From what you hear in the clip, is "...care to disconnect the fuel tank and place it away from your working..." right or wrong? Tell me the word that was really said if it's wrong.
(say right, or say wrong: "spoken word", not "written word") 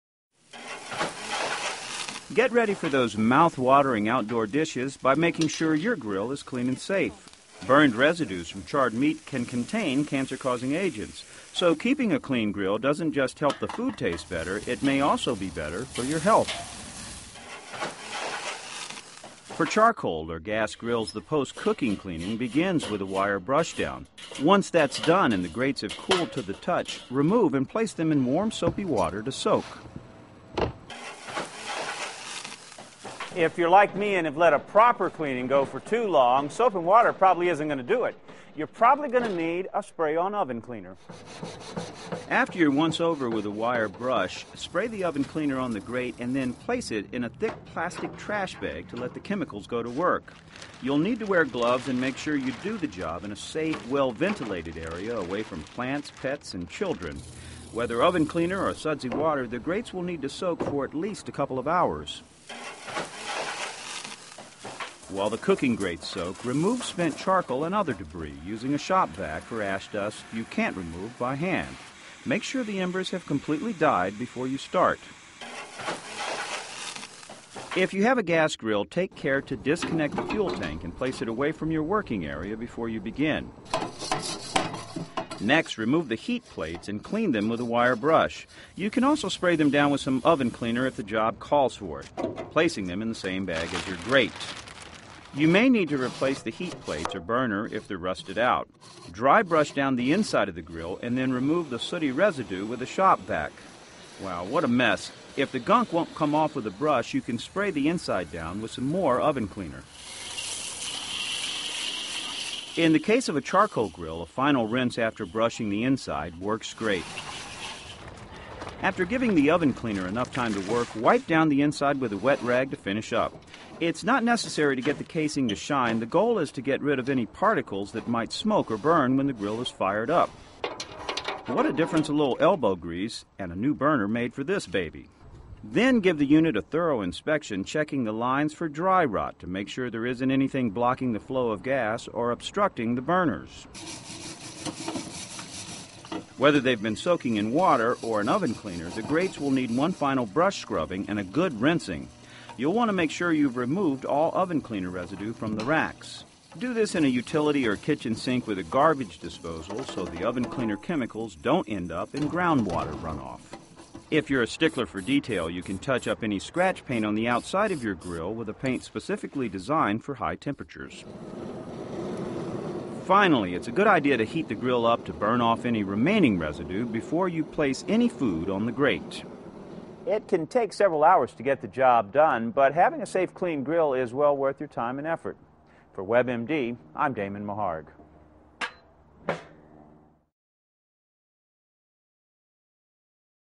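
right.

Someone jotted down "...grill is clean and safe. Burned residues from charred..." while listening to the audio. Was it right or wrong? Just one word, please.
right.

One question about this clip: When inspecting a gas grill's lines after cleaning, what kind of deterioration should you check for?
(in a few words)
dry rot.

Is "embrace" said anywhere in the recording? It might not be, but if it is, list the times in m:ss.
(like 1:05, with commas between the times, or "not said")
not said.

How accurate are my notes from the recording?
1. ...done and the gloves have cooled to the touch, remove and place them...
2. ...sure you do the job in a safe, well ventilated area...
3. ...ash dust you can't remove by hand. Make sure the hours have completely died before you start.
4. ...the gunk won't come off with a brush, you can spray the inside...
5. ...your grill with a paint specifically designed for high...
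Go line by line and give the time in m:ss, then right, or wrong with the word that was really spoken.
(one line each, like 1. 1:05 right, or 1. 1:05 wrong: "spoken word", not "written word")
1. 0:25 wrong: "grates", not "gloves"
2. 0:52 right
3. 1:09 wrong: "embers", not "hours"
4. 1:45 right
5. 2:47 right.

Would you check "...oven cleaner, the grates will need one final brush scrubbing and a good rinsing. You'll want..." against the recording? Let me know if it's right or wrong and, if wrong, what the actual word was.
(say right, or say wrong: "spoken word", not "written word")
right.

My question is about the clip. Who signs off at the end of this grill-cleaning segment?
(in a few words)
Damon Maharg.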